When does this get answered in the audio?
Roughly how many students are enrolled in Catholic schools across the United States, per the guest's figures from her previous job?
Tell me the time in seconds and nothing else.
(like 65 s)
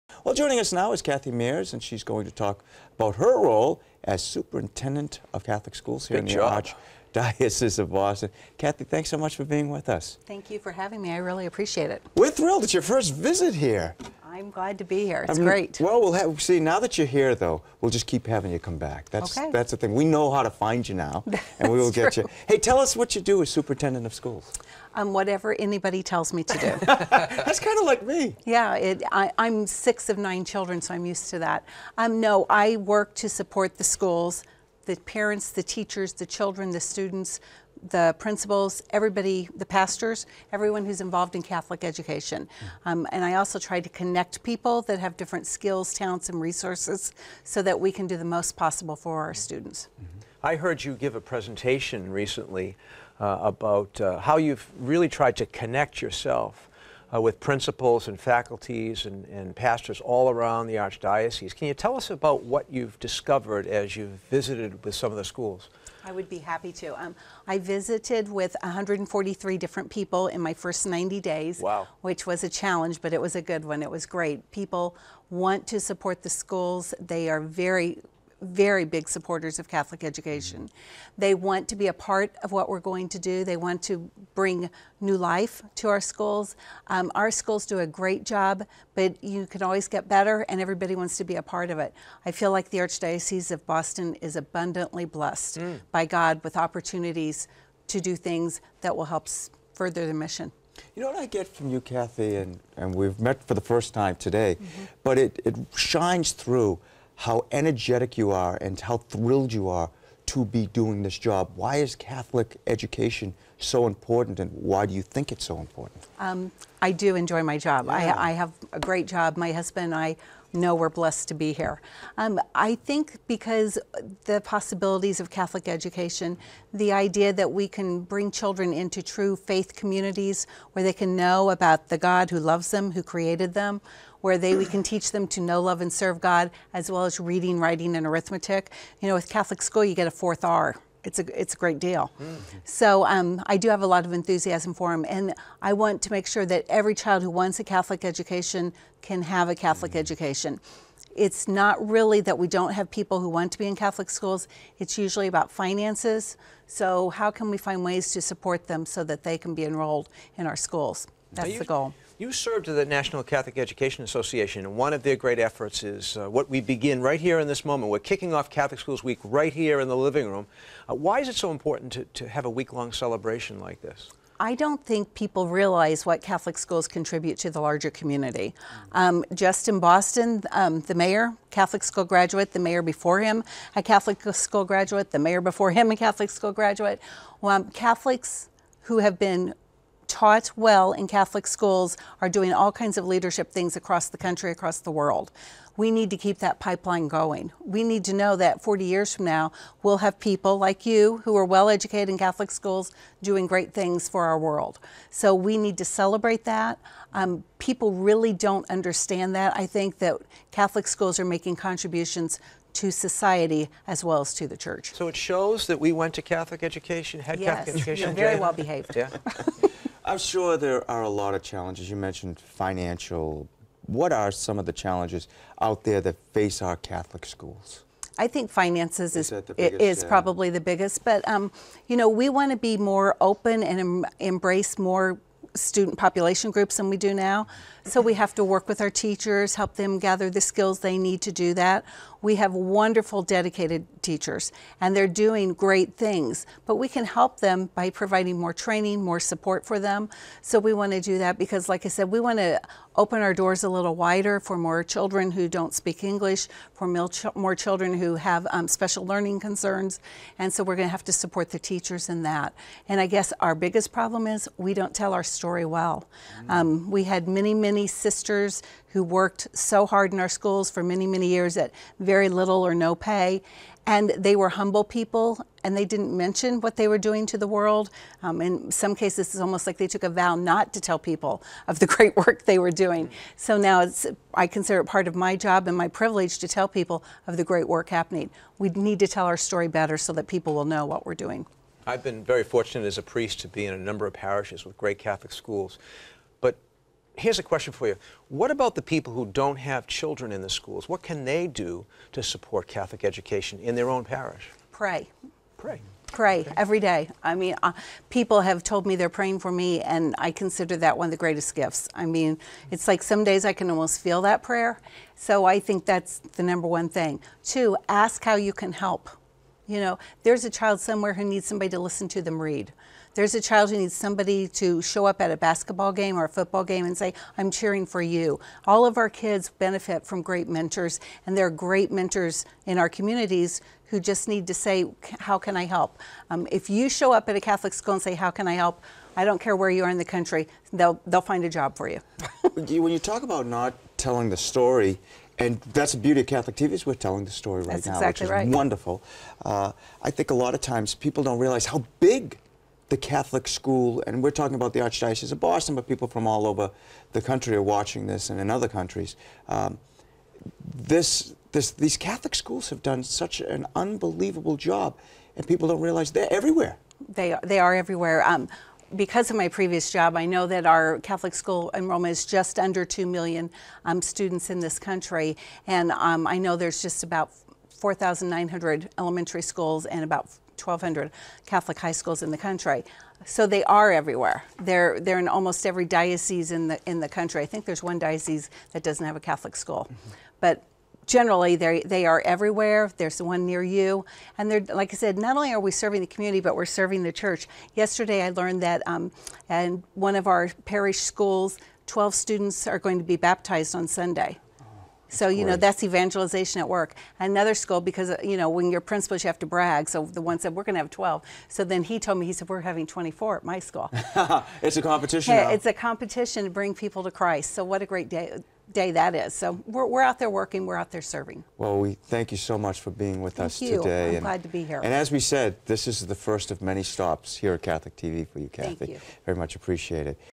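372 s.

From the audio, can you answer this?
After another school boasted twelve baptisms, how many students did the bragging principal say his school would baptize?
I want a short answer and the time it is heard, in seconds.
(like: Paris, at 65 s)
24, at 412 s.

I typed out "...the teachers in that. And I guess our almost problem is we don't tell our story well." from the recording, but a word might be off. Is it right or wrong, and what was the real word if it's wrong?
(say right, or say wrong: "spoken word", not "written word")
wrong: "biggest", not "almost".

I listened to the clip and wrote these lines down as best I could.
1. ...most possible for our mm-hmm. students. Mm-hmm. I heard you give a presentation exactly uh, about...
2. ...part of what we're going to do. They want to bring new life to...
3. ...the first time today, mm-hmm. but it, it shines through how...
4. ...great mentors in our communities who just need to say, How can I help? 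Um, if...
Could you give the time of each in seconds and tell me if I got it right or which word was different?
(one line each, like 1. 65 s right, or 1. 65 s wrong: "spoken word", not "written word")
1. 48 s wrong: "recently", not "exactly"
2. 81 s right
3. 103 s right
4. 331 s right.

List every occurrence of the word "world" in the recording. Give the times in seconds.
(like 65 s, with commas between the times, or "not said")
194 s, 204 s, 277 s.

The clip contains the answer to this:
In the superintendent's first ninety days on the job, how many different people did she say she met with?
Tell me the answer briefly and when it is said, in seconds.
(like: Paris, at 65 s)
143, at 68 s.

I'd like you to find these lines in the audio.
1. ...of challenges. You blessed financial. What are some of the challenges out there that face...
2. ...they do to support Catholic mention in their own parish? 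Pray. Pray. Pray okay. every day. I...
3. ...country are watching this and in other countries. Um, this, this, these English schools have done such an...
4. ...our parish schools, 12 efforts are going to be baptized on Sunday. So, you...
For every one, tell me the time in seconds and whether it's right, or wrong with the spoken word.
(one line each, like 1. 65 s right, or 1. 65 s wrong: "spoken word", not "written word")
1. 221 s wrong: "mentioned", not "blessed"
2. 301 s wrong: "education", not "mention"
3. 357 s wrong: "Catholic", not "English"
4. 400 s wrong: "students", not "efforts".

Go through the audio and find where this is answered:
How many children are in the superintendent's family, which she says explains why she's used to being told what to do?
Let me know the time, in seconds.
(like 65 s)
30 s.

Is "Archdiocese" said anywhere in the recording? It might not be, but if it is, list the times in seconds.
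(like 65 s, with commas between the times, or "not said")
7 s, 60 s, 92 s, 354 s.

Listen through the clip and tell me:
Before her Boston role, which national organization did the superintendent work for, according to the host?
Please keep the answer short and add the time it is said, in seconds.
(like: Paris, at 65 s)
National Catholic Education Association, at 162 s.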